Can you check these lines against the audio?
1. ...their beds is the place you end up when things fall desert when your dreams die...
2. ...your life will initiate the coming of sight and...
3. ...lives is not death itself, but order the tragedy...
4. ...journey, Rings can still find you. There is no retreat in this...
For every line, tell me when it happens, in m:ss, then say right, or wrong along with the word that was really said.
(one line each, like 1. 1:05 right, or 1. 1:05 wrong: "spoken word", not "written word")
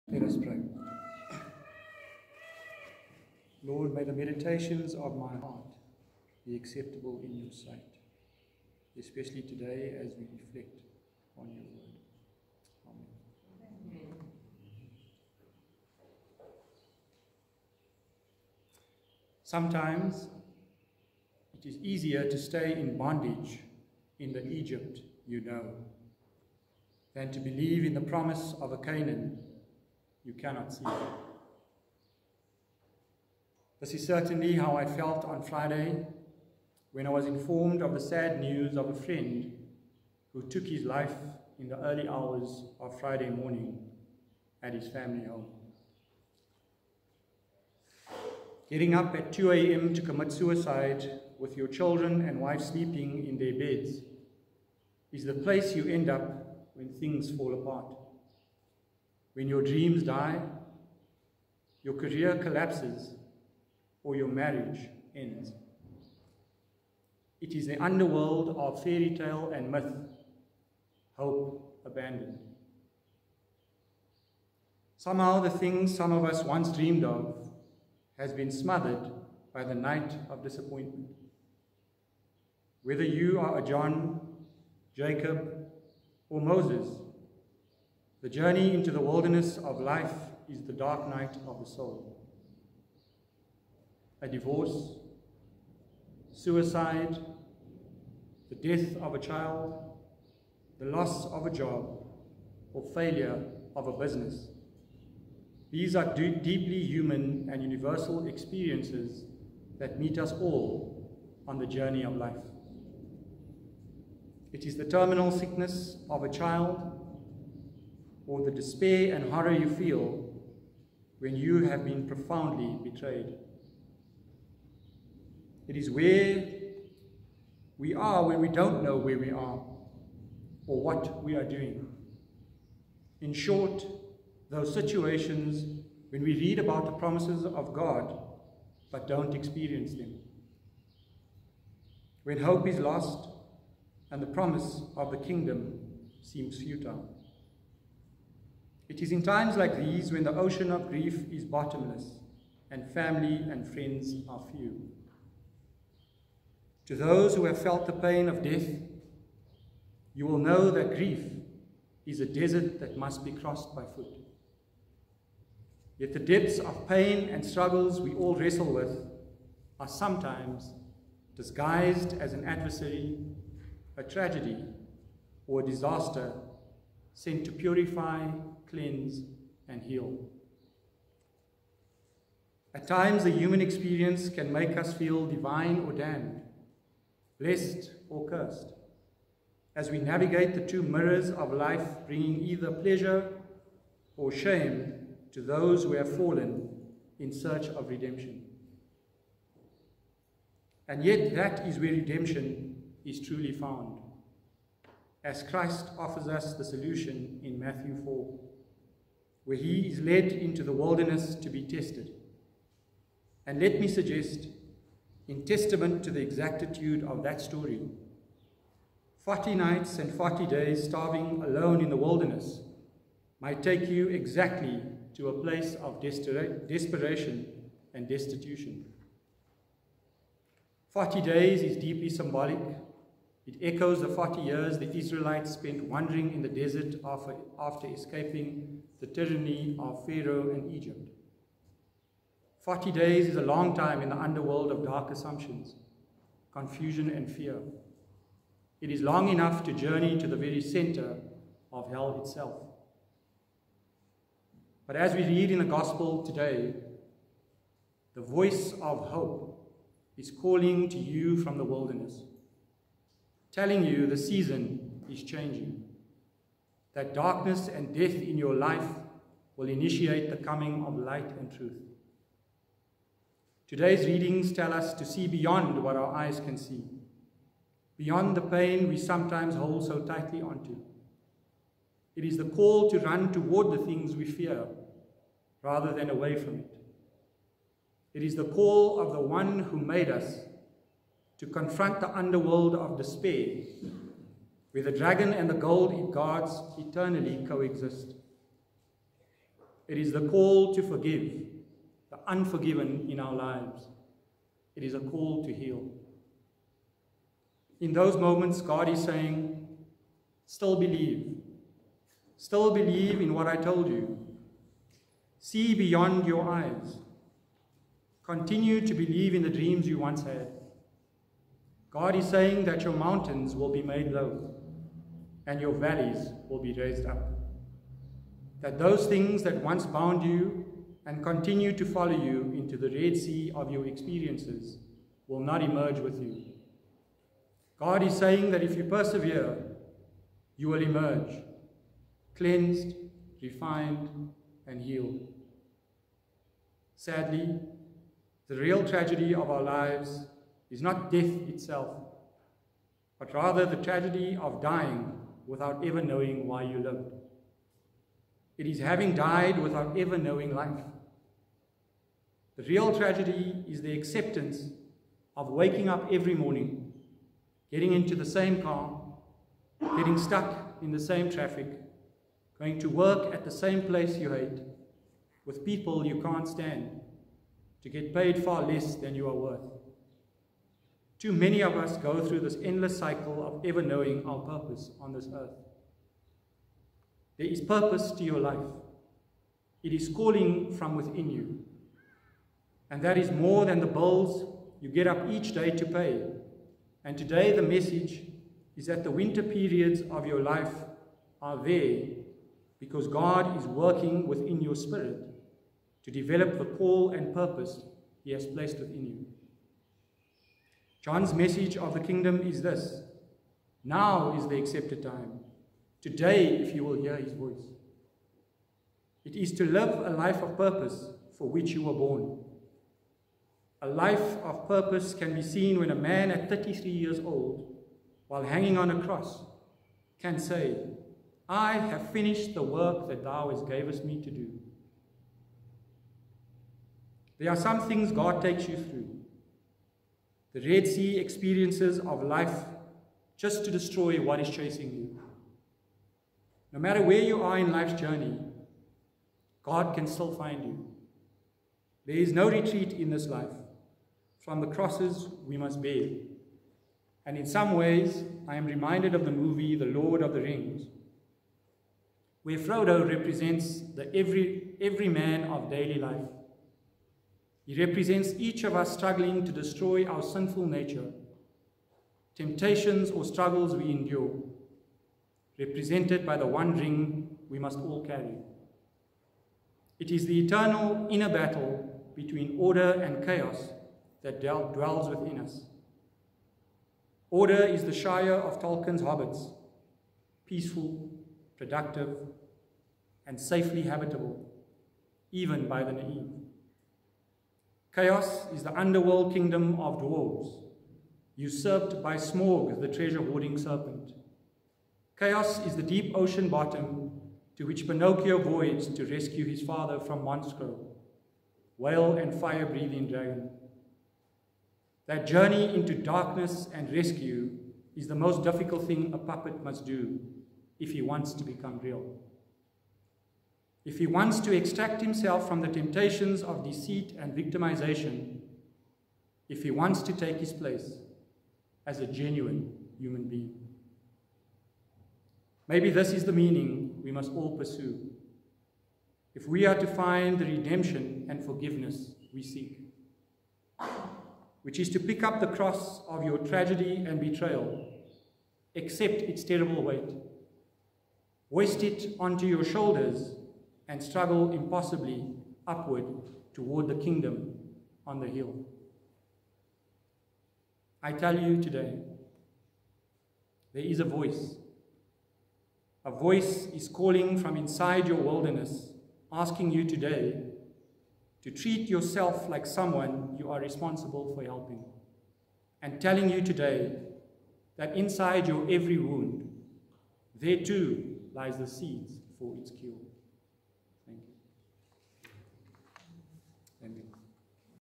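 1. 0:53 wrong: "apart", not "desert"
2. 4:28 wrong: "light", not "sight"
3. 5:49 wrong: "rather", not "order"
4. 7:27 wrong: "God", not "Rings".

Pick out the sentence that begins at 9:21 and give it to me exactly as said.
I tell you today, there is a voice.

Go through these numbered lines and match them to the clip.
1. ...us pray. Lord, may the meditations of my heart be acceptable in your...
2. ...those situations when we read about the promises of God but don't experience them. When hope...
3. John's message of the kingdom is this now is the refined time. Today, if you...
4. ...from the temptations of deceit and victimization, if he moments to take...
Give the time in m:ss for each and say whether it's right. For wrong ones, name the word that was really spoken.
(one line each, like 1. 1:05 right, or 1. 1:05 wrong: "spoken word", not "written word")
1. 0:00 right
2. 2:14 right
3. 6:51 wrong: "accepted", not "refined"
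4. 8:45 wrong: "wants", not "moments".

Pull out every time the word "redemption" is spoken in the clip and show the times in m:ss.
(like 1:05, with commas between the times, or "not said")
3:17, 3:21, 9:00.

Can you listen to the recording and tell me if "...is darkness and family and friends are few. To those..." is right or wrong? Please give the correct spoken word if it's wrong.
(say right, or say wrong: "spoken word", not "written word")
wrong: "bottomless", not "darkness".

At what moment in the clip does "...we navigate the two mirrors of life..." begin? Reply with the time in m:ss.
3:09.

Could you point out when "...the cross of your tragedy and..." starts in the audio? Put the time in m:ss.
9:05.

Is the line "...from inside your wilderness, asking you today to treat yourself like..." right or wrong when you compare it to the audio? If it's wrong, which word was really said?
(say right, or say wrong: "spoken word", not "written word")
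right.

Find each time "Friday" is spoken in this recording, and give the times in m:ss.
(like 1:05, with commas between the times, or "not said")
0:35, 0:42.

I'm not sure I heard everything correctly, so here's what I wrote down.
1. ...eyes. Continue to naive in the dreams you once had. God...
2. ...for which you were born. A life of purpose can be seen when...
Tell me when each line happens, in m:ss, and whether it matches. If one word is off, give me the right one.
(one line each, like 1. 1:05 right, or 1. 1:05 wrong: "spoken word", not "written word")
1. 5:16 wrong: "believe", not "naive"
2. 7:01 right.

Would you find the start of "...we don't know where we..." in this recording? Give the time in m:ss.
2:08.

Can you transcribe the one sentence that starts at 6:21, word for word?
Too many of us go through this endless cycle of ever knowing our purpose on this earth.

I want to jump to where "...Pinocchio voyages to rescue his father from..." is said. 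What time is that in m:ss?
8:27.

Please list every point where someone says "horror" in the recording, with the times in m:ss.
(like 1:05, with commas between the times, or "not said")
1:59.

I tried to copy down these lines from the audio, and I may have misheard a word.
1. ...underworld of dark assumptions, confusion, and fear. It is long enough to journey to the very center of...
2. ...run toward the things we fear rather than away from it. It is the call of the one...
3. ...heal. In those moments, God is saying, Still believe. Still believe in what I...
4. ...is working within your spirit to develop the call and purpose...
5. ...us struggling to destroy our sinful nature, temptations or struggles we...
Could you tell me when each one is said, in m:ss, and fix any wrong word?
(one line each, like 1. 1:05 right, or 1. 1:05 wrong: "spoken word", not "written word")
1. 4:04 right
2. 4:42 right
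3. 5:05 right
4. 6:43 right
5. 7:48 right.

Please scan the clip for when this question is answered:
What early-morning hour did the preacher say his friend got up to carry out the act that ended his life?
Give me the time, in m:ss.
0:49.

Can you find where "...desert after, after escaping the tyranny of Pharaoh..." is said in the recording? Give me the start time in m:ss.
3:56.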